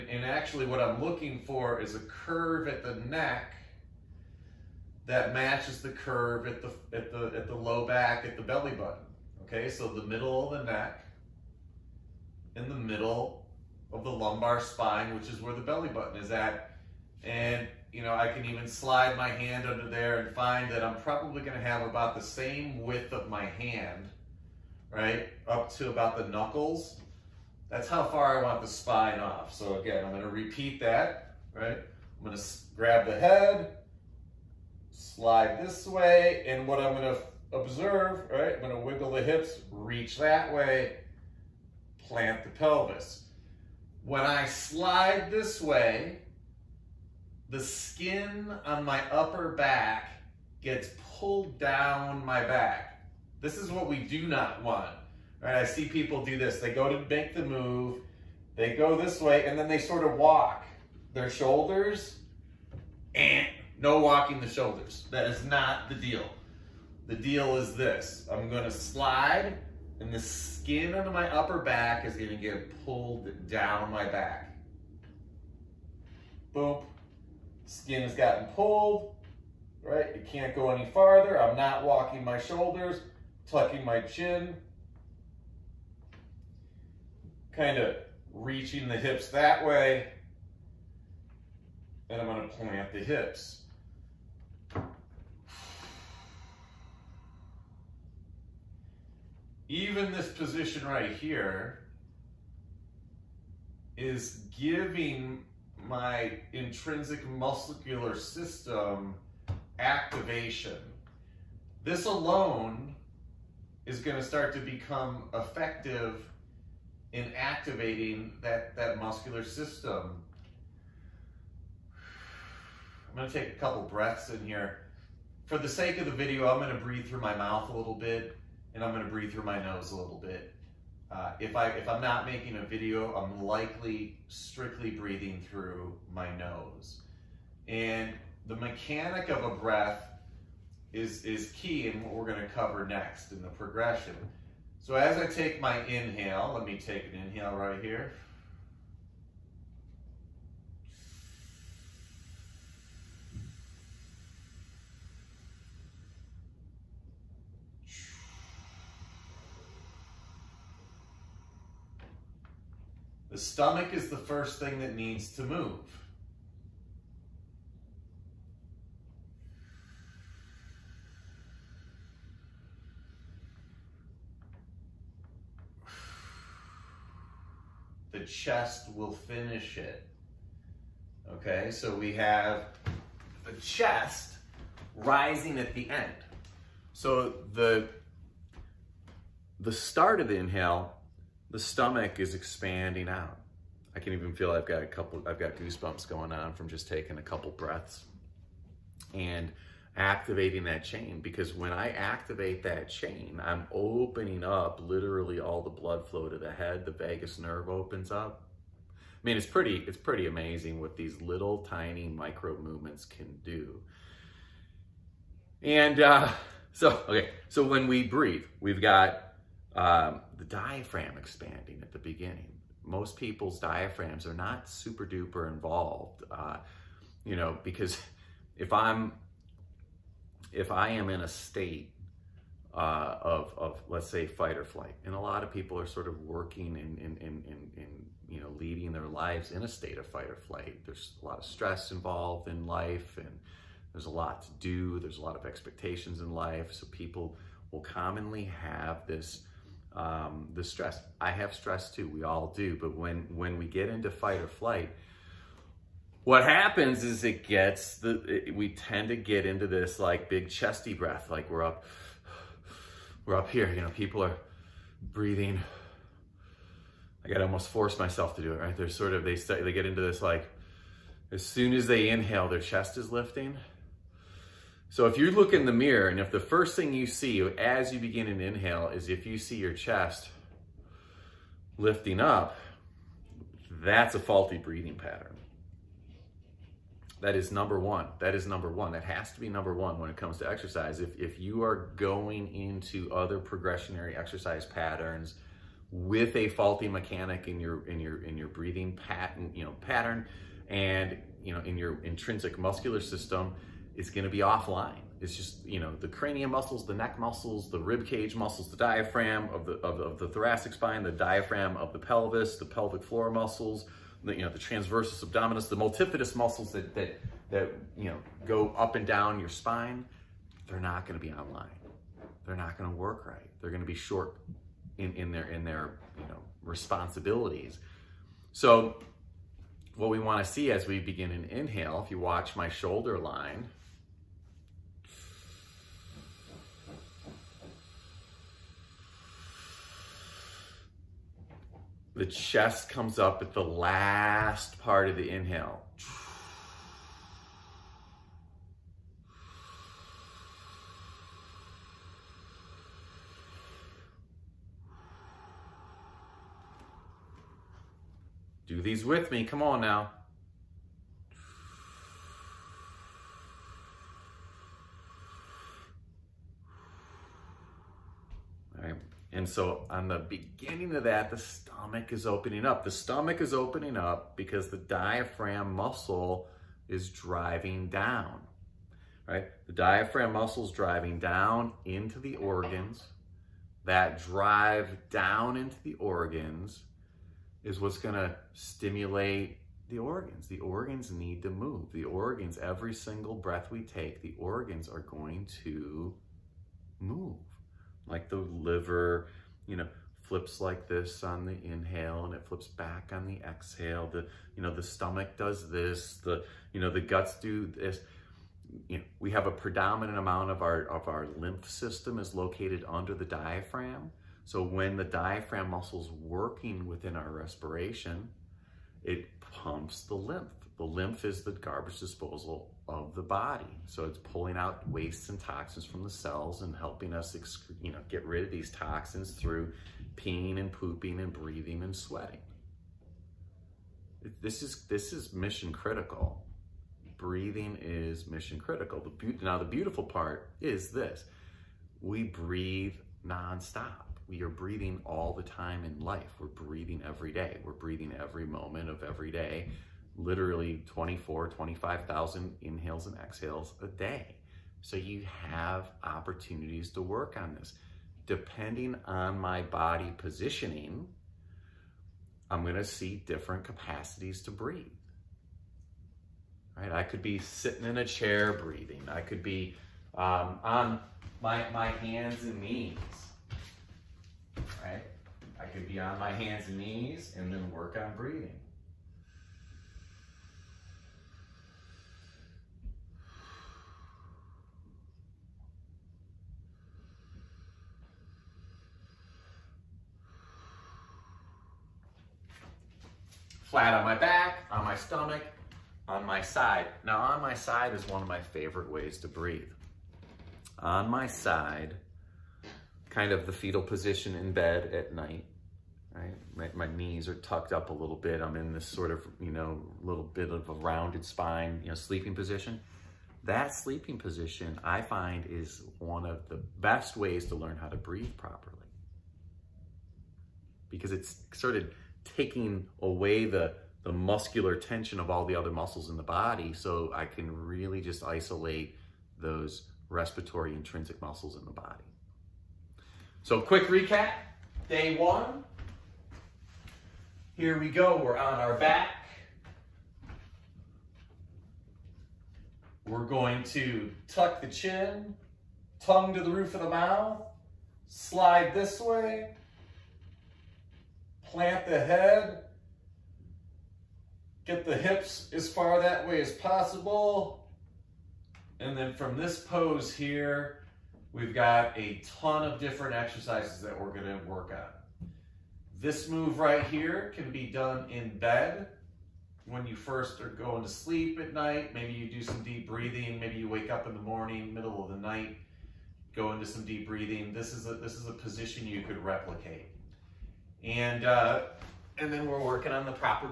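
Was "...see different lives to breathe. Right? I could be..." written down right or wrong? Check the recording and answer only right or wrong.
wrong.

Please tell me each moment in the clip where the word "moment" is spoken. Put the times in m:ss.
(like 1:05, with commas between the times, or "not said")
7:28.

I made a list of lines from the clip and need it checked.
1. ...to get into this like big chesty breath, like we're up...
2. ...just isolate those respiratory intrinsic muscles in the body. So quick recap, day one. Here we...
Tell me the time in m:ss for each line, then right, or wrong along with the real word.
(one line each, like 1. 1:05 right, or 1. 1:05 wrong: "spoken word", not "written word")
1. 4:19 right
2. 8:47 right.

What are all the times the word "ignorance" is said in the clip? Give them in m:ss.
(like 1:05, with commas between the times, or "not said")
not said.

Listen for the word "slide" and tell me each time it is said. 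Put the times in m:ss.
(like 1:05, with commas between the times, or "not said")
0:18, 0:34, 0:44, 1:08, 9:08.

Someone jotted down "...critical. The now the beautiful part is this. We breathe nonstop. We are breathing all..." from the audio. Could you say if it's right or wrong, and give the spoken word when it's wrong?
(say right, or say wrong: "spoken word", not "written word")
right.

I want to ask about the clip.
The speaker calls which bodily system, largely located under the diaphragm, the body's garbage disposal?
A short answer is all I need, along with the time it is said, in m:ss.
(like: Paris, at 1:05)
lymph system, at 6:51.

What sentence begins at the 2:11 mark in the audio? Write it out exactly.
Uh, if, I, if I'm not making a video, I'm likely strictly breathing through my nose.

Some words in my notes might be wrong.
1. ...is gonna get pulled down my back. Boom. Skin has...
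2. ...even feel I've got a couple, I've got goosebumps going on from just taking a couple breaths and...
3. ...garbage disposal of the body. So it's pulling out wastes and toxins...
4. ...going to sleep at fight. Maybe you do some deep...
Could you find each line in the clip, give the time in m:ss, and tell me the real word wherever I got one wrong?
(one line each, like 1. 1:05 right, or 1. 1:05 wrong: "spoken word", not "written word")
1. 1:12 right
2. 3:14 right
3. 7:01 right
4. 9:30 wrong: "night", not "fight".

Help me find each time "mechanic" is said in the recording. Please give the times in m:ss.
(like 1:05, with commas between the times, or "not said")
2:18, 4:56.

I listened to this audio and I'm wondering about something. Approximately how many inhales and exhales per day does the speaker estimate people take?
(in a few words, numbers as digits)
24,000 to 25,000.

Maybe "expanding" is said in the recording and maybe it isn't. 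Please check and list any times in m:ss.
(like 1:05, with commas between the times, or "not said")
3:12, 3:41.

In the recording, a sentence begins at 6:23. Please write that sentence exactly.
That drive down into the organs is what's gonna stimulate the organs.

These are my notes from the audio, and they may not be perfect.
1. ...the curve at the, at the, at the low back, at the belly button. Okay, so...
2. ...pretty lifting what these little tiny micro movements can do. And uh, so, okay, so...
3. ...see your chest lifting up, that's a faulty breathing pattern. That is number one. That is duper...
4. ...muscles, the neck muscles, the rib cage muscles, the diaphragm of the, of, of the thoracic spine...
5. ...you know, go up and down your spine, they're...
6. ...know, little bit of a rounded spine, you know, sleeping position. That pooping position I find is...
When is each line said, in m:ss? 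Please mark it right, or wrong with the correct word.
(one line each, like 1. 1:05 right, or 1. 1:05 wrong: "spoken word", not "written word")
1. 0:05 right
2. 3:29 wrong: "amazing", not "lifting"
3. 4:39 wrong: "number", not "duper"
4. 5:06 right
5. 5:17 right
6. 8:29 wrong: "sleeping", not "pooping".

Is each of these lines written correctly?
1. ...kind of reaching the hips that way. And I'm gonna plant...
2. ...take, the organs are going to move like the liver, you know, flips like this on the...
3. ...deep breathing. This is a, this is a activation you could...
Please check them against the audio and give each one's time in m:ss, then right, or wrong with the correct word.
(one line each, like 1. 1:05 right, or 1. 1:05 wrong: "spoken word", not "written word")
1. 1:27 right
2. 6:33 right
3. 9:36 wrong: "position", not "activation".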